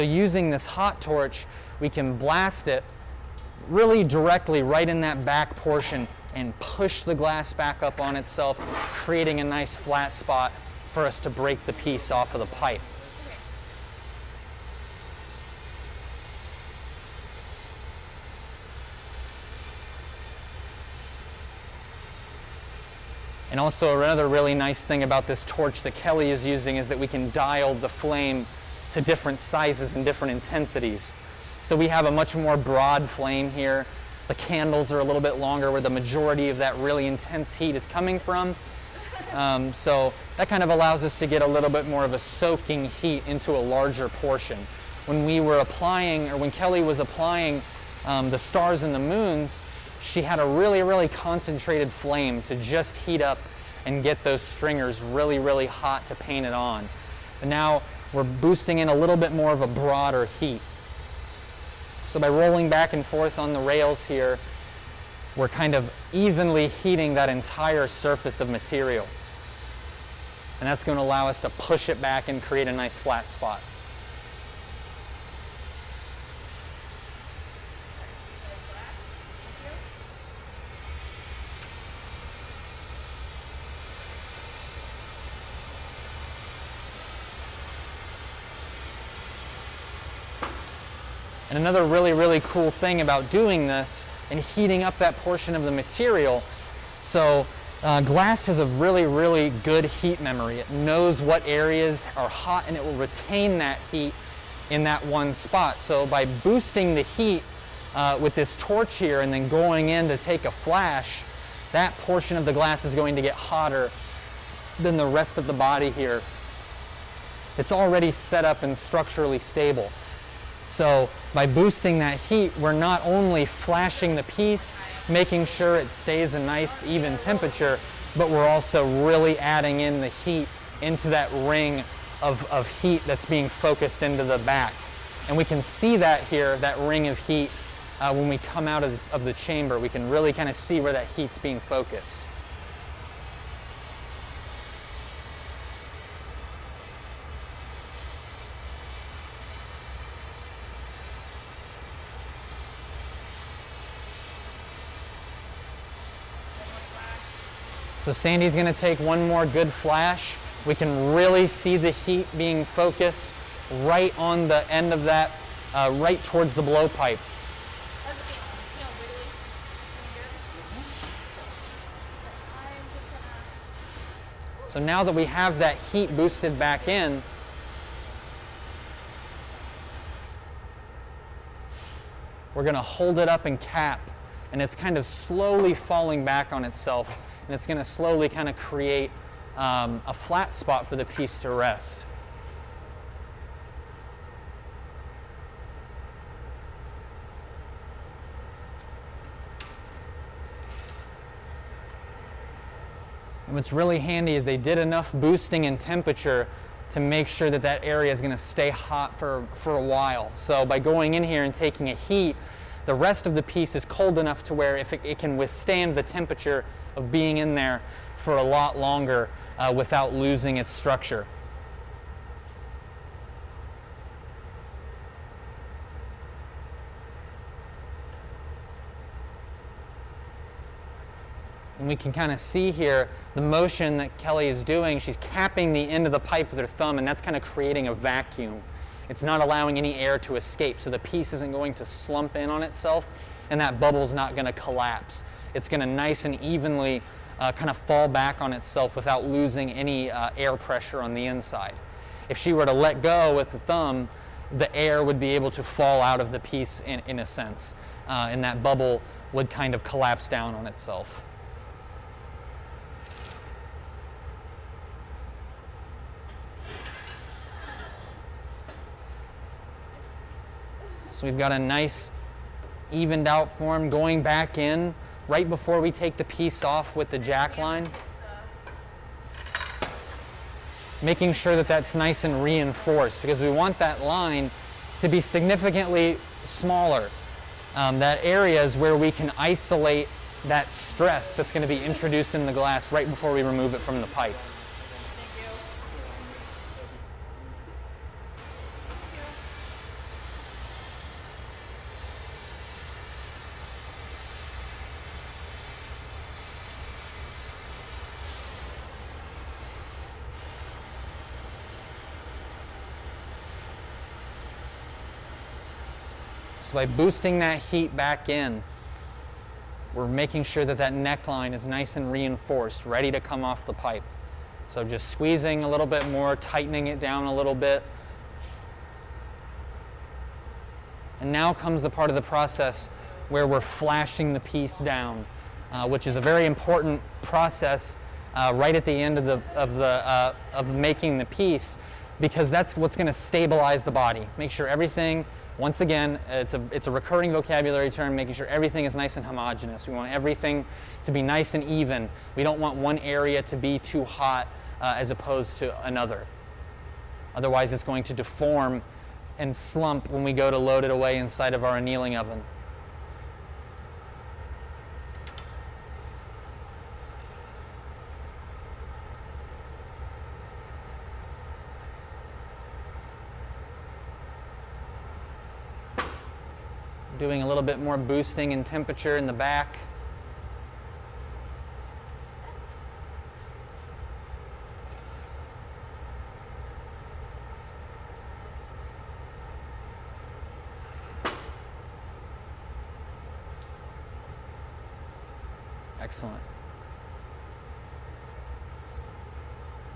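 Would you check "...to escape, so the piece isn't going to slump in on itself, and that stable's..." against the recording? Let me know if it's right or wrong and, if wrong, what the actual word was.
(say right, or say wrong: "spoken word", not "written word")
wrong: "bubble", not "stable".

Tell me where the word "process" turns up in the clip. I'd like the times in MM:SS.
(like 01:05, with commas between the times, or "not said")
05:32, 05:37.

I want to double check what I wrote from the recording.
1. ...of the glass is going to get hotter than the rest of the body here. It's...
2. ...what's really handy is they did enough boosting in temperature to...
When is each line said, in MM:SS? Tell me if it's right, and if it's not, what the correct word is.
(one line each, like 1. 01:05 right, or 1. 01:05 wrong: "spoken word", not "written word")
1. 01:52 right
2. 03:23 right.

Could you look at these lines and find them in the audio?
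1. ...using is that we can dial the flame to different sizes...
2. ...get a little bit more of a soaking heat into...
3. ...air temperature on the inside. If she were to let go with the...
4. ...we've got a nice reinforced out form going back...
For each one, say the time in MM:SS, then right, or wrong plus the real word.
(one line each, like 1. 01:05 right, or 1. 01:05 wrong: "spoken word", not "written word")
1. 00:26 right
2. 00:41 right
3. 04:10 wrong: "pressure", not "temperature"
4. 04:31 wrong: "evened", not "reinforced".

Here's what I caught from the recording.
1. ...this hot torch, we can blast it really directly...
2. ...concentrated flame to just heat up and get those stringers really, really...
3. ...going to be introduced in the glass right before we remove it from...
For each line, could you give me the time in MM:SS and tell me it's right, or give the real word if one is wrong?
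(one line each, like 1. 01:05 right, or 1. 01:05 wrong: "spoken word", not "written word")
1. 00:00 right
2. 00:51 right
3. 04:51 right.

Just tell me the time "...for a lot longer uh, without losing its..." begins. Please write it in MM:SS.
03:38.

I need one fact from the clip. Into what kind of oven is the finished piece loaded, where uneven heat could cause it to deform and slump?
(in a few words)
Annealing oven.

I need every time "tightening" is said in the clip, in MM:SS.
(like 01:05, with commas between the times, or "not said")
05:26.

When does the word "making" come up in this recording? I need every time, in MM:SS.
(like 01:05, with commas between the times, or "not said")
02:05, 04:41, 05:20, 05:40, 05:48.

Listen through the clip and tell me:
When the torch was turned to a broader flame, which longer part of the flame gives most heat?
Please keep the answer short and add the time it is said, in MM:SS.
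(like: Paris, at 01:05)
The candles, at 00:34.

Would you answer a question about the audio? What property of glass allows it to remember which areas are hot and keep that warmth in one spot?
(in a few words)
Heat memory.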